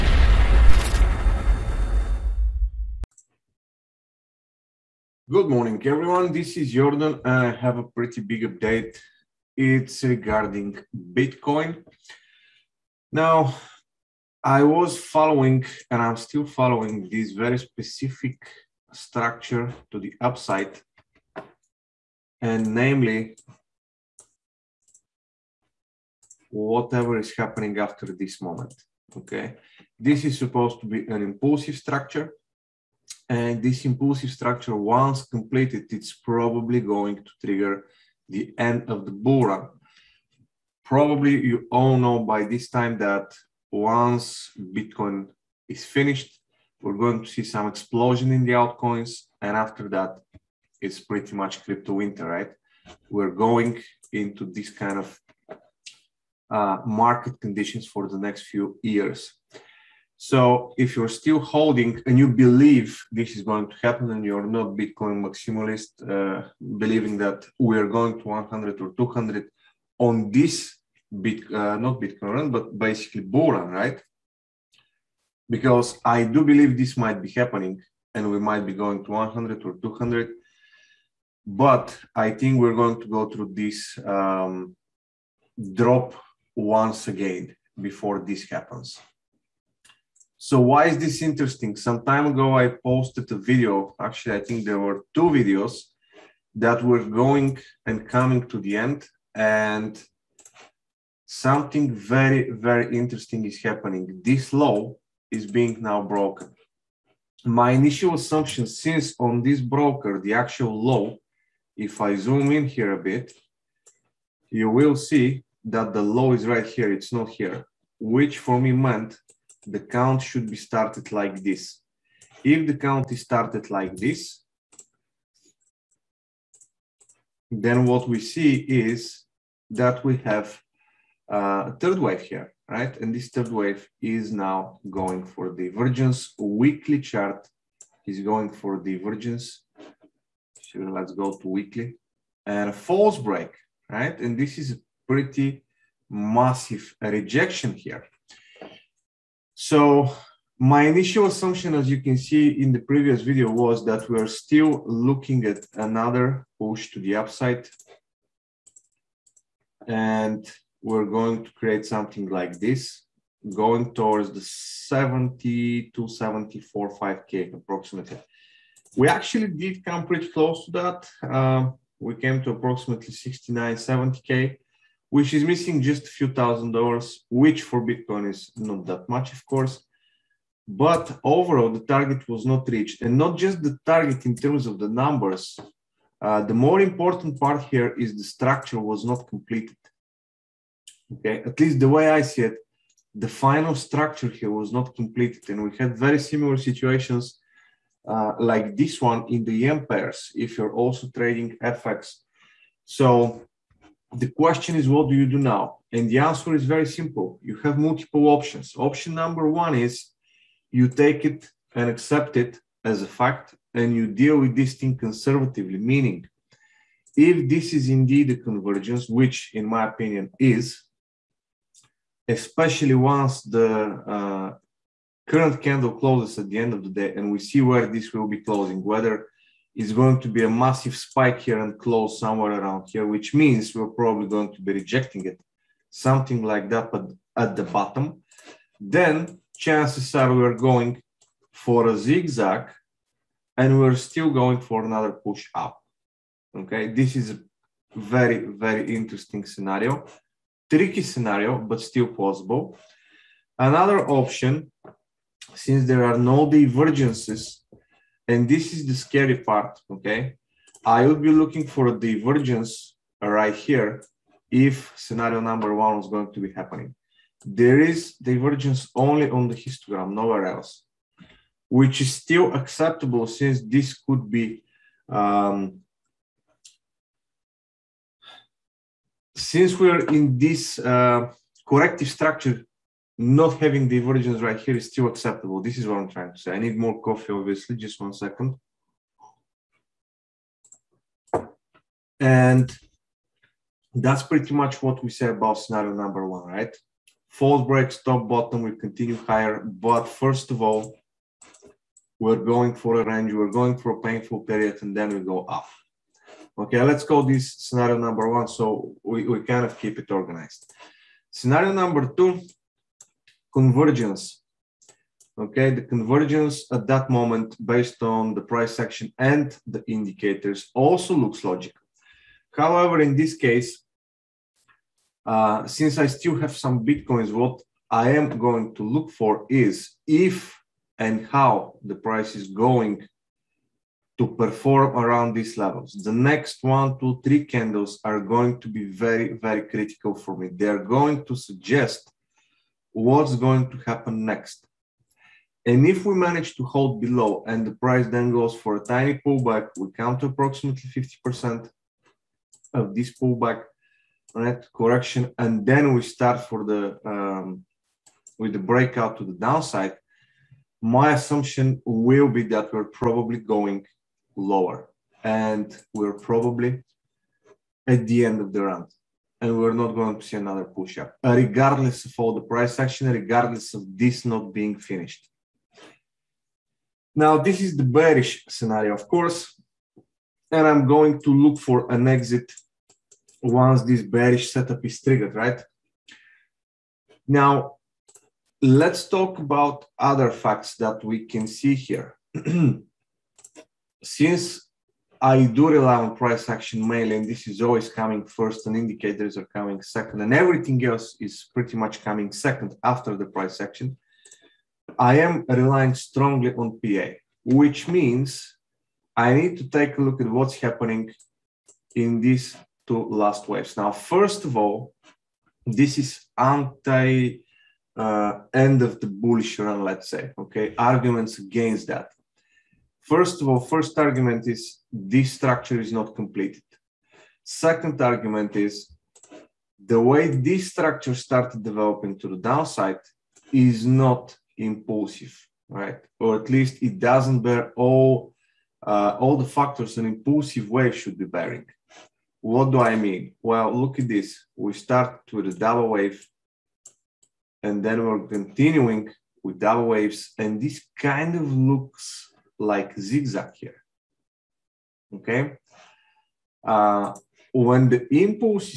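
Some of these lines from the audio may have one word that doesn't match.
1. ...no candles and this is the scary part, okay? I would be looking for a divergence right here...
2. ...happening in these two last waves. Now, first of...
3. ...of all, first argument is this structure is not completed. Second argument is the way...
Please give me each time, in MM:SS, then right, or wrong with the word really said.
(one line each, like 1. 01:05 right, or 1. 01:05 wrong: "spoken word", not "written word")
1. 04:16 wrong: "divergences", not "candles"
2. 06:50 right
3. 07:03 right.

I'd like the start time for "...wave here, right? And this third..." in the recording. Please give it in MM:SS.
02:11.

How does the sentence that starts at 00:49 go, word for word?
And after that, it's pretty much crypto winter, right?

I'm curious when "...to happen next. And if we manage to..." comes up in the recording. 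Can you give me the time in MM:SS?
05:43.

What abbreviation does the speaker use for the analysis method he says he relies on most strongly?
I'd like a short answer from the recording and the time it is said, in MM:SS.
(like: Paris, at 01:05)
PA, at 06:46.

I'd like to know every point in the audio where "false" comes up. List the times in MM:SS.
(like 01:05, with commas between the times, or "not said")
02:22, 04:57.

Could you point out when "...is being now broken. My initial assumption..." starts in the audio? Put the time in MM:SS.
01:45.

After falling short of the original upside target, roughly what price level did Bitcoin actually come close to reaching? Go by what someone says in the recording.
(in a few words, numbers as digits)
69-70K.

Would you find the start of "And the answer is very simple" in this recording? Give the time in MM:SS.
03:25.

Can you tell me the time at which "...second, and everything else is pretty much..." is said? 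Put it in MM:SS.
06:39.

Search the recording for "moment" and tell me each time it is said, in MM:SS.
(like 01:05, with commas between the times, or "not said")
00:28, 05:17.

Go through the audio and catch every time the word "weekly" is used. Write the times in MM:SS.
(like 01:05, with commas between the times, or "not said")
02:16, 02:21.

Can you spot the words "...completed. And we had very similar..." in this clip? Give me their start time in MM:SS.
03:14.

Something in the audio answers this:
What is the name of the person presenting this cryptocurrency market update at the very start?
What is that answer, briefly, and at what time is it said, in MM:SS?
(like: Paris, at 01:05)
Yordan, at 00:06.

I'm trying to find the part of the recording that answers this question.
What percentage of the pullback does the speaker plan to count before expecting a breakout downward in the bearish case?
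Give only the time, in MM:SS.
05:50.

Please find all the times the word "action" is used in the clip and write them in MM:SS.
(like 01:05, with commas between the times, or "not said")
05:18, 06:12, 06:36, 06:43.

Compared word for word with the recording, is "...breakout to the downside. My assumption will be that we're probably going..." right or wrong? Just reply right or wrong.
right.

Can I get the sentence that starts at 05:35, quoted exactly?
The next one, two, three candles are going to be very, very critical for me.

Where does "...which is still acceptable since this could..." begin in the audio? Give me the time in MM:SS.
04:31.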